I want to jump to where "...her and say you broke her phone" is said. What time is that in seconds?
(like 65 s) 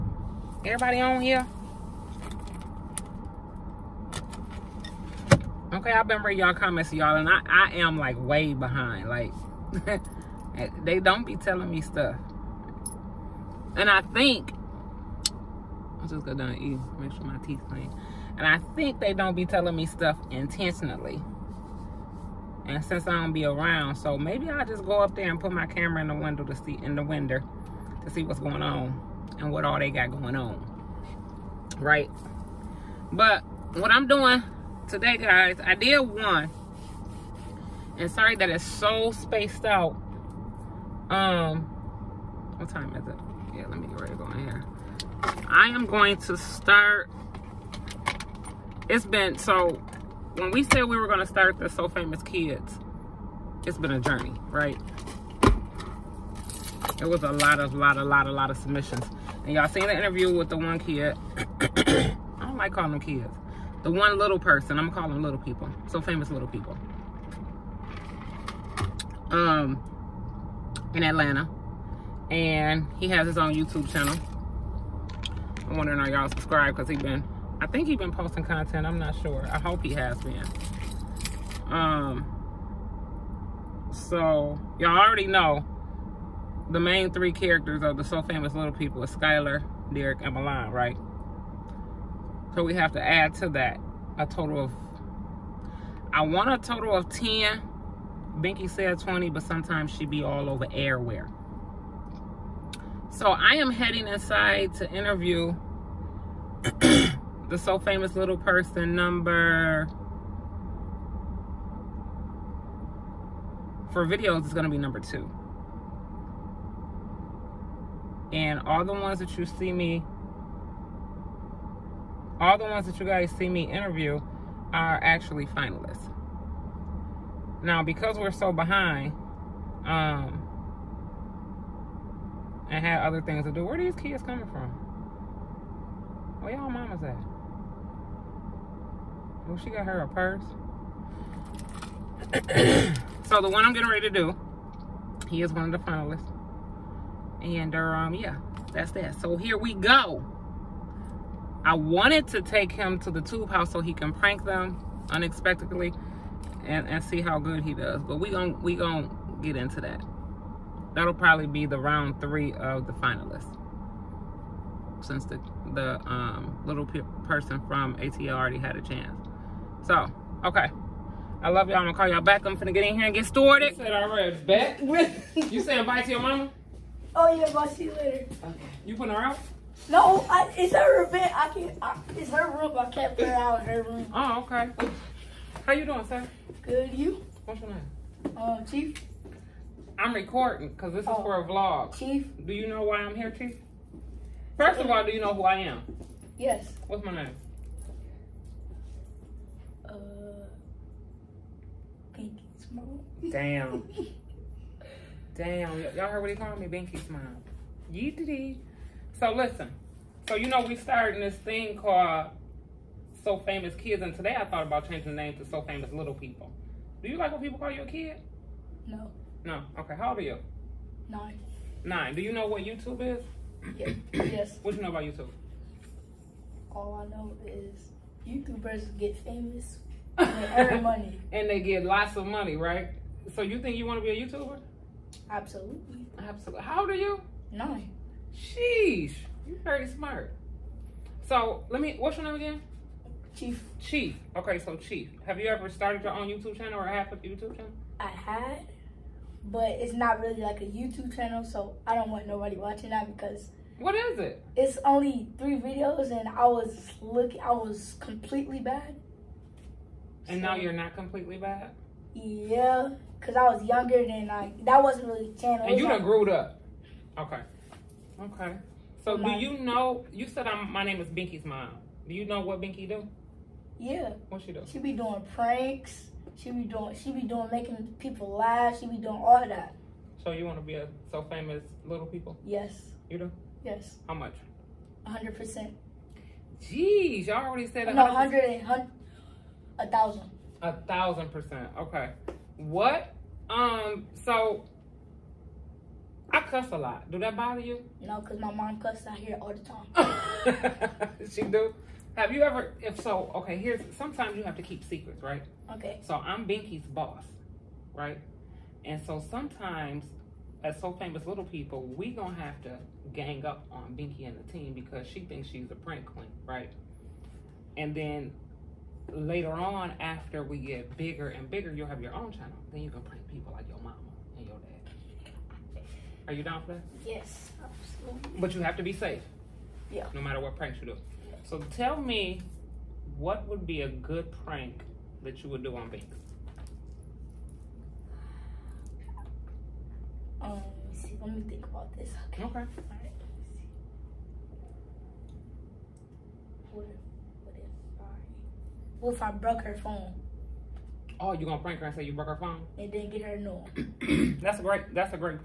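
351 s.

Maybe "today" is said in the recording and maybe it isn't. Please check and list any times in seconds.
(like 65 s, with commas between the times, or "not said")
34 s, 214 s.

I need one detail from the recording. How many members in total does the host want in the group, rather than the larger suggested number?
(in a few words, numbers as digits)
10.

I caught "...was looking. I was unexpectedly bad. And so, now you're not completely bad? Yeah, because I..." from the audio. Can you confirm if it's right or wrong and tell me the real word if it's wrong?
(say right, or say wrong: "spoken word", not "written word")
wrong: "completely", not "unexpectedly".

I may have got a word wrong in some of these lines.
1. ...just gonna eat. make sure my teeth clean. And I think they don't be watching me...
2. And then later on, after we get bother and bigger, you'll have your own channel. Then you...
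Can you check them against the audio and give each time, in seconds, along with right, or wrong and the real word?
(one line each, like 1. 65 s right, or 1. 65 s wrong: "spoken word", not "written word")
1. 16 s wrong: "telling", not "watching"
2. 317 s wrong: "bigger", not "bother".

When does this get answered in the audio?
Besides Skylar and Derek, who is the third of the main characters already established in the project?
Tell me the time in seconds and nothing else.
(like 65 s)
90 s.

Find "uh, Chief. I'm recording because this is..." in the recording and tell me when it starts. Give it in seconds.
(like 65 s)
188 s.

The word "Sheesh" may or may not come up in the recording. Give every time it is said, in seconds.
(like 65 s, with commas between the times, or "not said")
238 s.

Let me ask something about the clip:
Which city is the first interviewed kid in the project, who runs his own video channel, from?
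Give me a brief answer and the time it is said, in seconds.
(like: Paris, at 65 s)
Atlanta, at 71 s.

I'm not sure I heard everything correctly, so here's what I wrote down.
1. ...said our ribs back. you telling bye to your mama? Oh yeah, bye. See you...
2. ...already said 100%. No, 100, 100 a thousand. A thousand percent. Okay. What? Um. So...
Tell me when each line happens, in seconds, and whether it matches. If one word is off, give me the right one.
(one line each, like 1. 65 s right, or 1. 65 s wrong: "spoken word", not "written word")
1. 173 s wrong: "saying", not "telling"
2. 287 s right.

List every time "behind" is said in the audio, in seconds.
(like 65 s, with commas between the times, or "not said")
8 s, 128 s.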